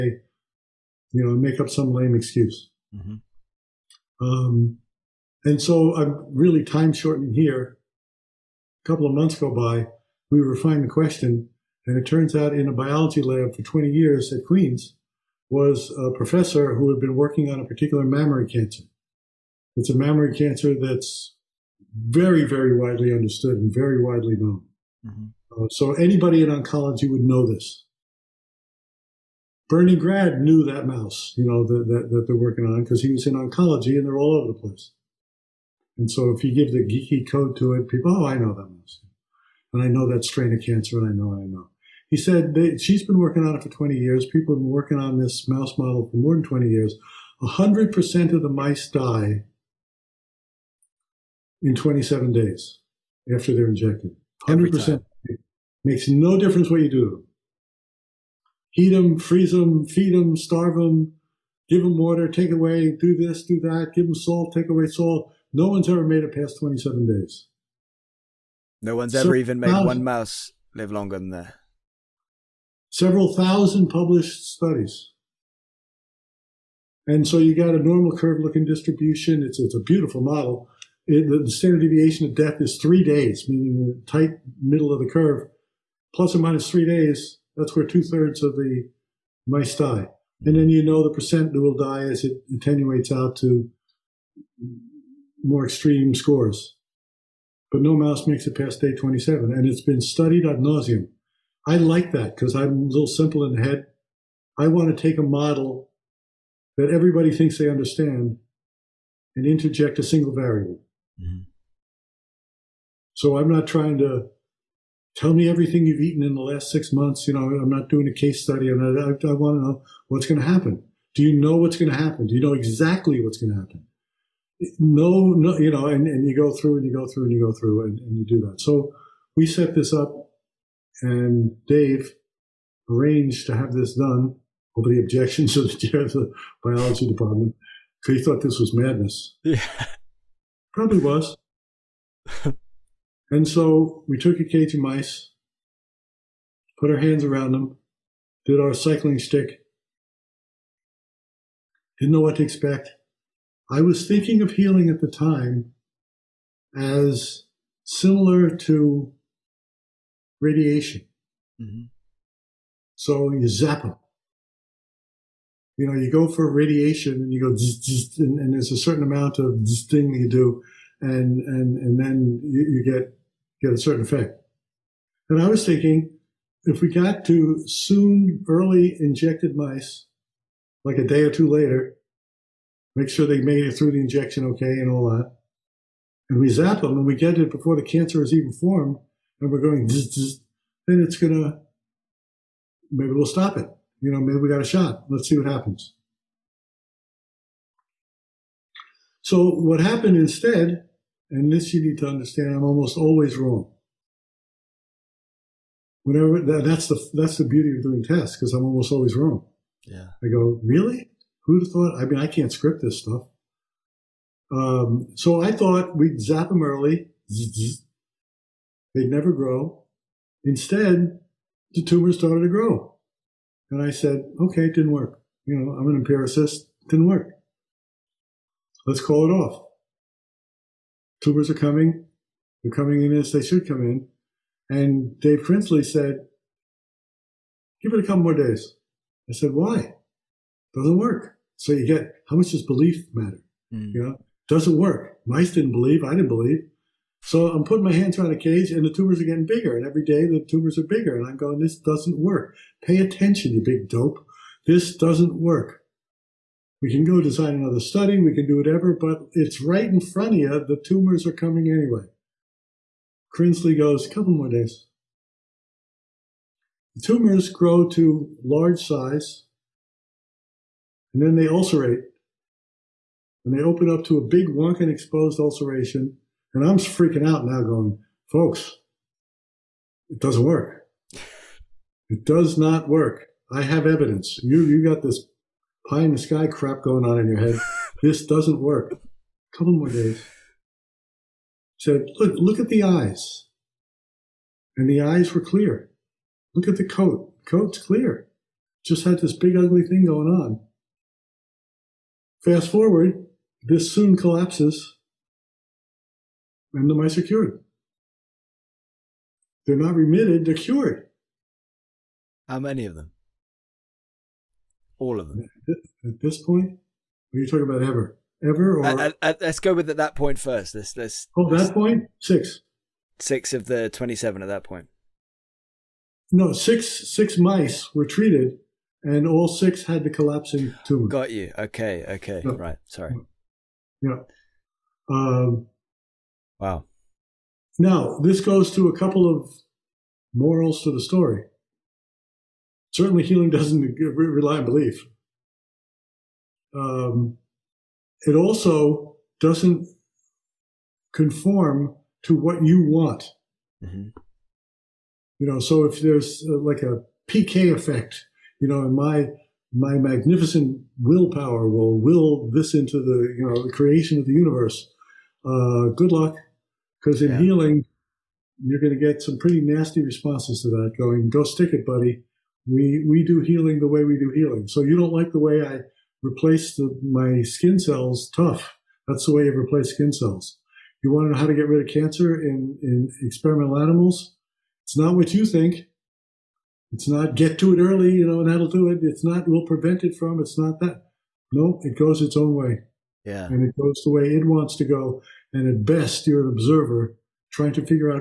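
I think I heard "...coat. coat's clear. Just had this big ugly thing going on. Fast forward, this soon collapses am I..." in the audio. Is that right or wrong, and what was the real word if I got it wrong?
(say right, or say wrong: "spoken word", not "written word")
right.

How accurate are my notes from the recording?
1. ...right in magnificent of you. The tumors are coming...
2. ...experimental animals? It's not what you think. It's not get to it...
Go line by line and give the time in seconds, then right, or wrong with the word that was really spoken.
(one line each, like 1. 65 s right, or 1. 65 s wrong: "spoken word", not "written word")
1. 259 s wrong: "front", not "magnificent"
2. 383 s right.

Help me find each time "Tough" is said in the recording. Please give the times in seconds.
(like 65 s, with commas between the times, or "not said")
378 s.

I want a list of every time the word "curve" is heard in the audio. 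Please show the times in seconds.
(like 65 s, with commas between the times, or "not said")
78 s, 85 s.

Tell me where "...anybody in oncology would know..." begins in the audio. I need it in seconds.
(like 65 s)
25 s.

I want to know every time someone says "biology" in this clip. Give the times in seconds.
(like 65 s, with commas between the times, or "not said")
12 s, 136 s.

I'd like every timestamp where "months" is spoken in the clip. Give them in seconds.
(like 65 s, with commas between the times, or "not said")
9 s, 116 s.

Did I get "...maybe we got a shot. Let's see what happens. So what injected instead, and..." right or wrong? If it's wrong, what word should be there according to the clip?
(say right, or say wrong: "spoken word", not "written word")
wrong: "happened", not "injected".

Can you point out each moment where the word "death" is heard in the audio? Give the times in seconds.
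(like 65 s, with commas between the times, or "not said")
82 s.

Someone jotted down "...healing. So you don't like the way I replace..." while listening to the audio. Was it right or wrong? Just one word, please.
right.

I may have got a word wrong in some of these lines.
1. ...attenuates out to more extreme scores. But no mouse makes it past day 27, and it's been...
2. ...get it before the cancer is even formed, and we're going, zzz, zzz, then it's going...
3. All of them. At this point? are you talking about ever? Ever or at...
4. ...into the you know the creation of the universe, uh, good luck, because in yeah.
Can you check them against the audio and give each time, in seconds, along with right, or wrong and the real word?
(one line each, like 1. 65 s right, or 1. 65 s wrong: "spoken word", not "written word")
1. 92 s right
2. 187 s right
3. 314 s right
4. 362 s right.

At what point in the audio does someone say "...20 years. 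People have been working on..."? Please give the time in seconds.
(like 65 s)
43 s.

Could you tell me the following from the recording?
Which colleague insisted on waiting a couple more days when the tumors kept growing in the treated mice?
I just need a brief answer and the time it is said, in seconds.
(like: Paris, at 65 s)
Dave Krinsley, at 235 s.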